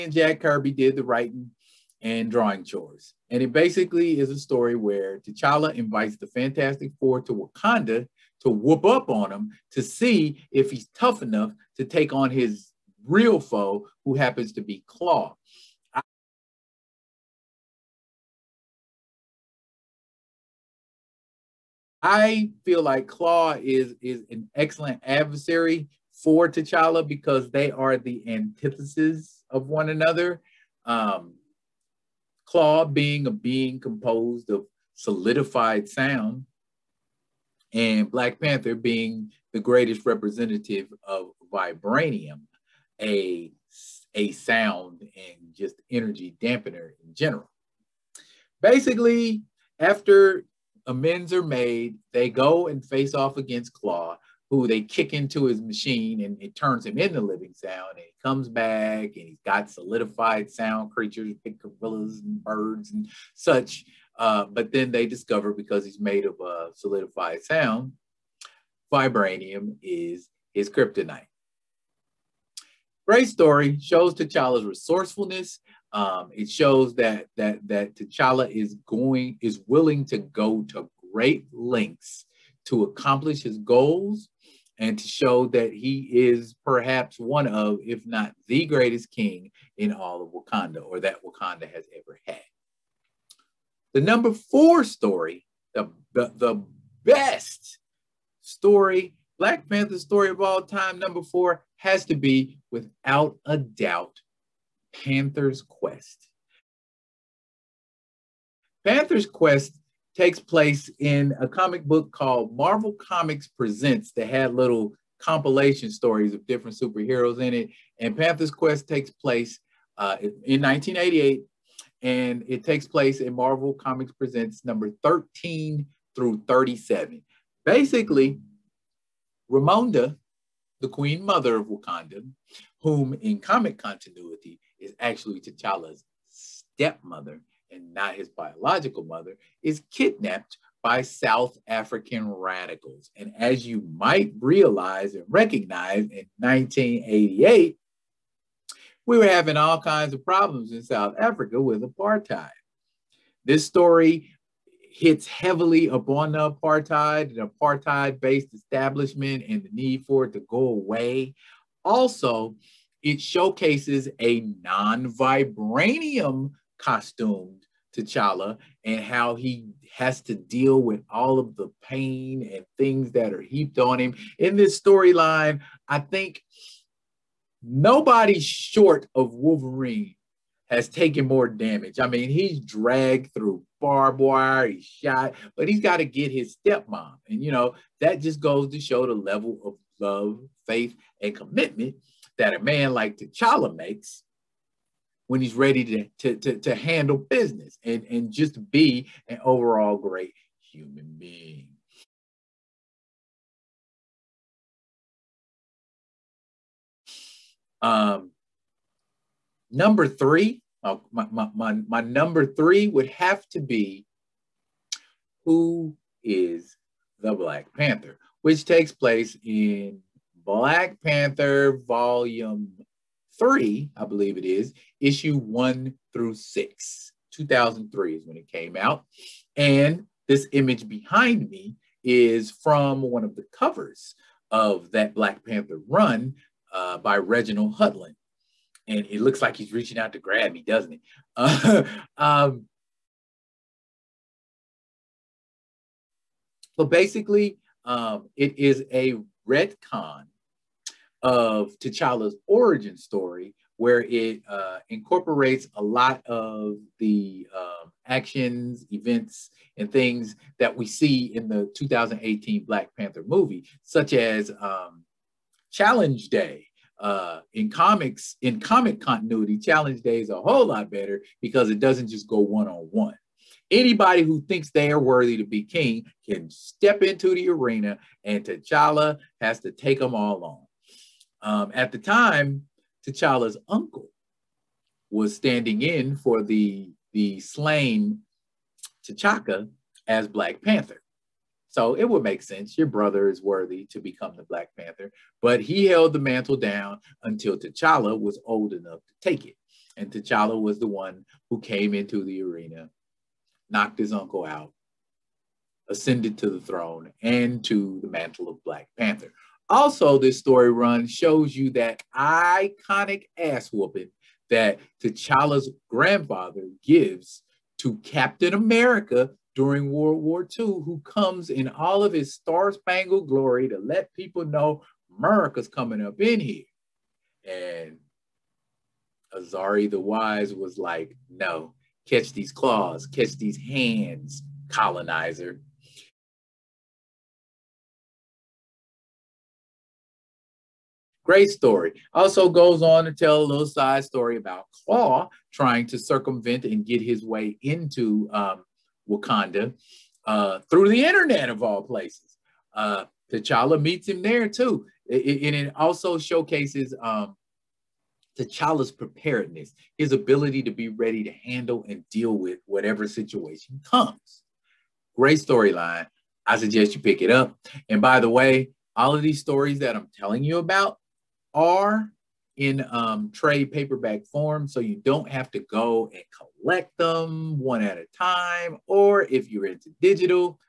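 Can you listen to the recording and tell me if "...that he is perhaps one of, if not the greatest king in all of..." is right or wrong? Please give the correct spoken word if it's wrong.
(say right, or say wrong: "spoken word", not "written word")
right.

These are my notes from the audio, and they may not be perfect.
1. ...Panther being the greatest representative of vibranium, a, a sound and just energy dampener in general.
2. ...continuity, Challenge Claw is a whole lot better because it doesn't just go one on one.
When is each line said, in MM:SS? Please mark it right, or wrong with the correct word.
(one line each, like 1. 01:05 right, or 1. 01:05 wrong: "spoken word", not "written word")
1. 00:38 right
2. 04:29 wrong: "Day", not "Claw".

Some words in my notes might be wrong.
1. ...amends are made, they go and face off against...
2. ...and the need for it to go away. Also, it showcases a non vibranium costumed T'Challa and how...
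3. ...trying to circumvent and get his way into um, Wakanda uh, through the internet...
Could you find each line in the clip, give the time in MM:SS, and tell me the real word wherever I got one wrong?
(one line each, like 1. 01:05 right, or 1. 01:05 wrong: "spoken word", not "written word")
1. 00:50 right
2. 02:39 right
3. 05:45 right.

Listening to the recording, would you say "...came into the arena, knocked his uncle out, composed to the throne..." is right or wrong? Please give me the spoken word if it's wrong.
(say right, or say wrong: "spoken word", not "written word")
wrong: "ascended", not "composed".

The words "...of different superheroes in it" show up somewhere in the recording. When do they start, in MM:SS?
01:56.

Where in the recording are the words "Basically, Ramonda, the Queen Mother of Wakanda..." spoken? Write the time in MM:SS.
02:07.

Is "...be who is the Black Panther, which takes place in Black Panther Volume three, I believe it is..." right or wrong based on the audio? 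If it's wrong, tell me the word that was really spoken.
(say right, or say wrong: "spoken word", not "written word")
right.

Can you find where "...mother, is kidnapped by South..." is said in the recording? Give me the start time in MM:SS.
02:19.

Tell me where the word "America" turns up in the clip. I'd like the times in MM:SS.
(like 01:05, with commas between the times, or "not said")
05:18, 05:25.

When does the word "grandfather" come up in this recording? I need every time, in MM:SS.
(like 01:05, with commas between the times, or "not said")
05:15.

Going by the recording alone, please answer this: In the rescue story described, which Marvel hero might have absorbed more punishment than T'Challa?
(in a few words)
Wolverine.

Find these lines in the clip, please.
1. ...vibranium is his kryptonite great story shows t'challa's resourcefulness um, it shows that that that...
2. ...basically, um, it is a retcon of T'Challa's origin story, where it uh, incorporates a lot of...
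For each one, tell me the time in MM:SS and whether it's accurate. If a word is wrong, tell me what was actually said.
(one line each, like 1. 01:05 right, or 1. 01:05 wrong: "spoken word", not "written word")
1. 01:08 right
2. 04:06 right.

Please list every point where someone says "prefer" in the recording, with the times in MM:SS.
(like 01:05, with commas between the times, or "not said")
not said.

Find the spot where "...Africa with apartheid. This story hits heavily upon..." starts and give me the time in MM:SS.
02:31.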